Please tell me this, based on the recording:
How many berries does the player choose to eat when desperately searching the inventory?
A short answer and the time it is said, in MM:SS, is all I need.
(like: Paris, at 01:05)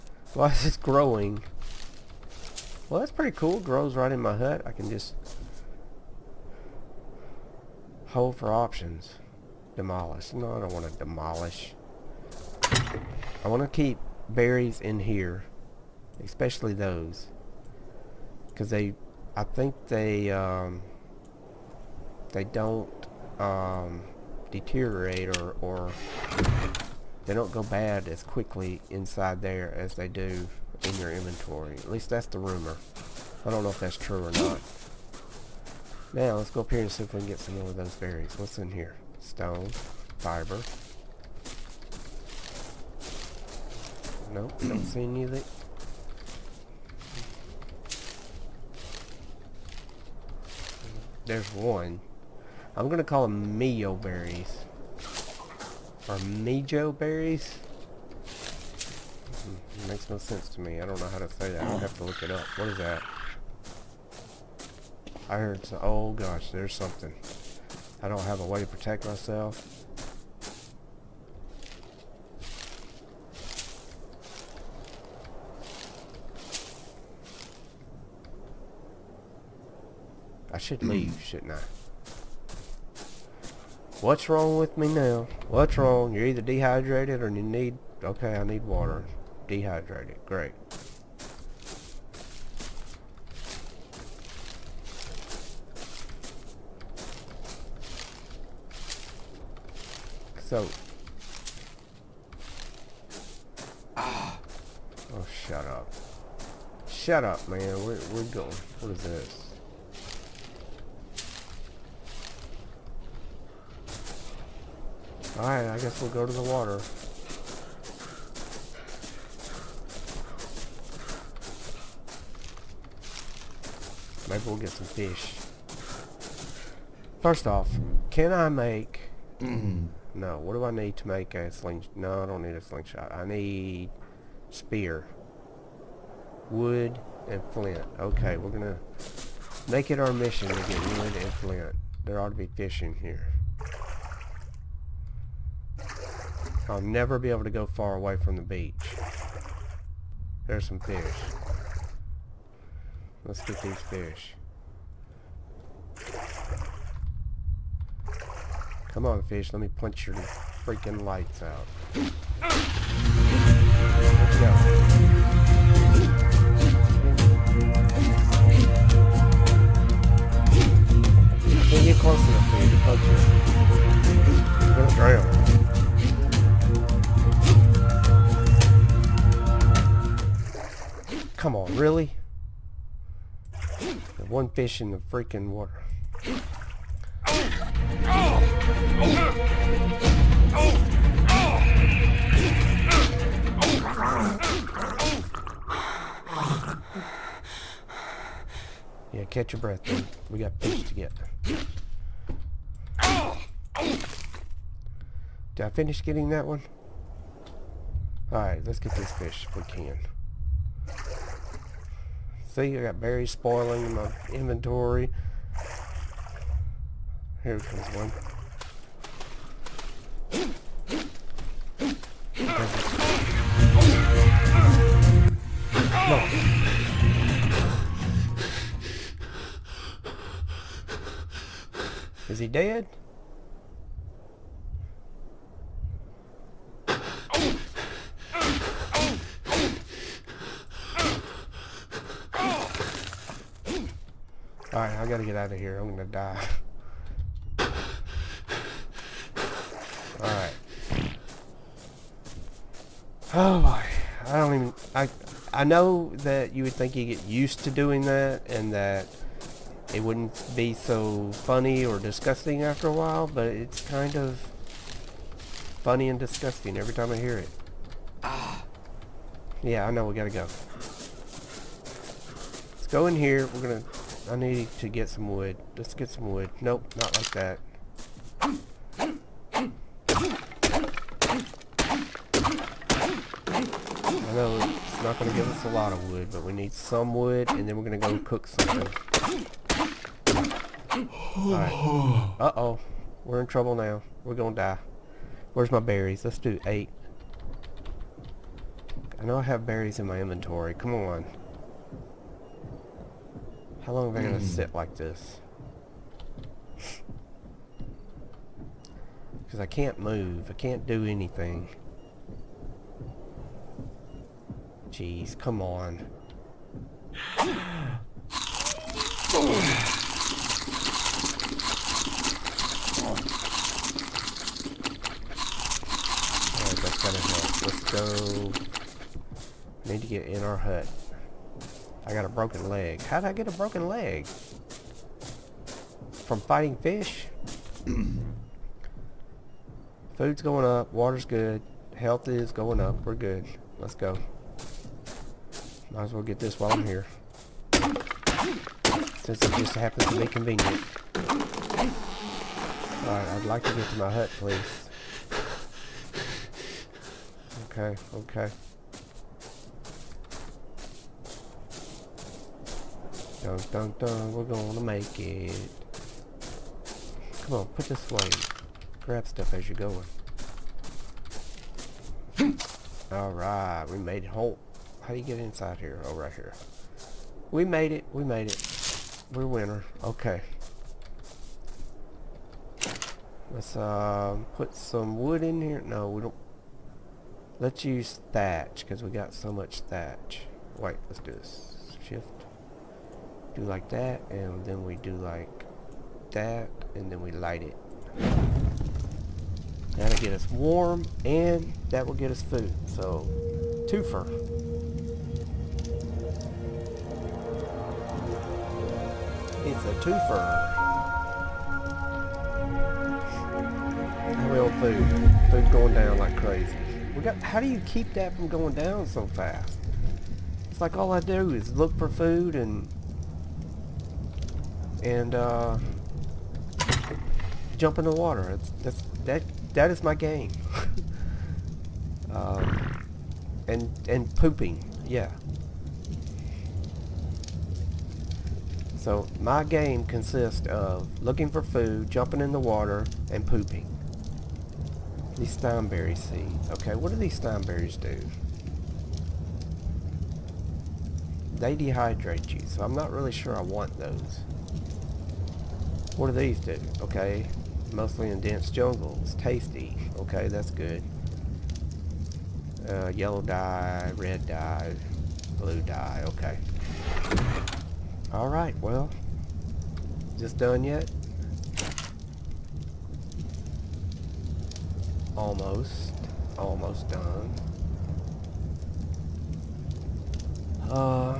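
8, at 04:56.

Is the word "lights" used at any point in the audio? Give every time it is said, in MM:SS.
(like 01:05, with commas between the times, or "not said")
02:41, 06:37.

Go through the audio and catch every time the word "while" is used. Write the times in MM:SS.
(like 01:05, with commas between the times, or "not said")
04:22, 05:46.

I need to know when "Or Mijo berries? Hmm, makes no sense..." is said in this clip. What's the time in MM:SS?
00:56.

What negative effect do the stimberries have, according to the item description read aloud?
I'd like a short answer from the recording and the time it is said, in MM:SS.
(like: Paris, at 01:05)
they dehydrate you, at 07:31.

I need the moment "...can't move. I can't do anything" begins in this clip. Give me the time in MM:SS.
05:09.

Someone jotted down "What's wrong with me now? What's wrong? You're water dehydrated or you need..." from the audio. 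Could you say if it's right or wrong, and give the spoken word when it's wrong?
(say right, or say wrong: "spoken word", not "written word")
wrong: "either", not "water".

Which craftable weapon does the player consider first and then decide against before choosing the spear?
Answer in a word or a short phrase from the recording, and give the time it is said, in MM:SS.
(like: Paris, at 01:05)
slingshot, at 02:12.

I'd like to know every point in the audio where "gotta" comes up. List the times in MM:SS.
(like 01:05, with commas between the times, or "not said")
04:05, 04:30.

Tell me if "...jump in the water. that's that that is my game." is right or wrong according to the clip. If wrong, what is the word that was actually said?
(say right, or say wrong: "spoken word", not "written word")
right.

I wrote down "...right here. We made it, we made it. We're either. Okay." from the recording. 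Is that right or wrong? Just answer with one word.
wrong.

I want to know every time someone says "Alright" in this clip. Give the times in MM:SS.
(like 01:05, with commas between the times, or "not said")
01:55, 03:28, 04:04, 04:10, 05:53, 06:13, 07:48.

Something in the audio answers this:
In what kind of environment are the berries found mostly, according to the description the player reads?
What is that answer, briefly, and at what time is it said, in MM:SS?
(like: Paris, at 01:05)
dense jungles, at 07:38.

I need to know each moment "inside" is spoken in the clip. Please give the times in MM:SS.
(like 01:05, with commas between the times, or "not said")
00:28, 06:15.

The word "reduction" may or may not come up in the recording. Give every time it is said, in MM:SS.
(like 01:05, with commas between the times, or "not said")
not said.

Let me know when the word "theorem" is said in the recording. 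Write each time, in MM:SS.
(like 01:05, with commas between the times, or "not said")
not said.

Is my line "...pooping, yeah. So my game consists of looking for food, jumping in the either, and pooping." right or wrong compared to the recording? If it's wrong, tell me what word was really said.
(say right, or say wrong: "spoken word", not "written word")
wrong: "water", not "either".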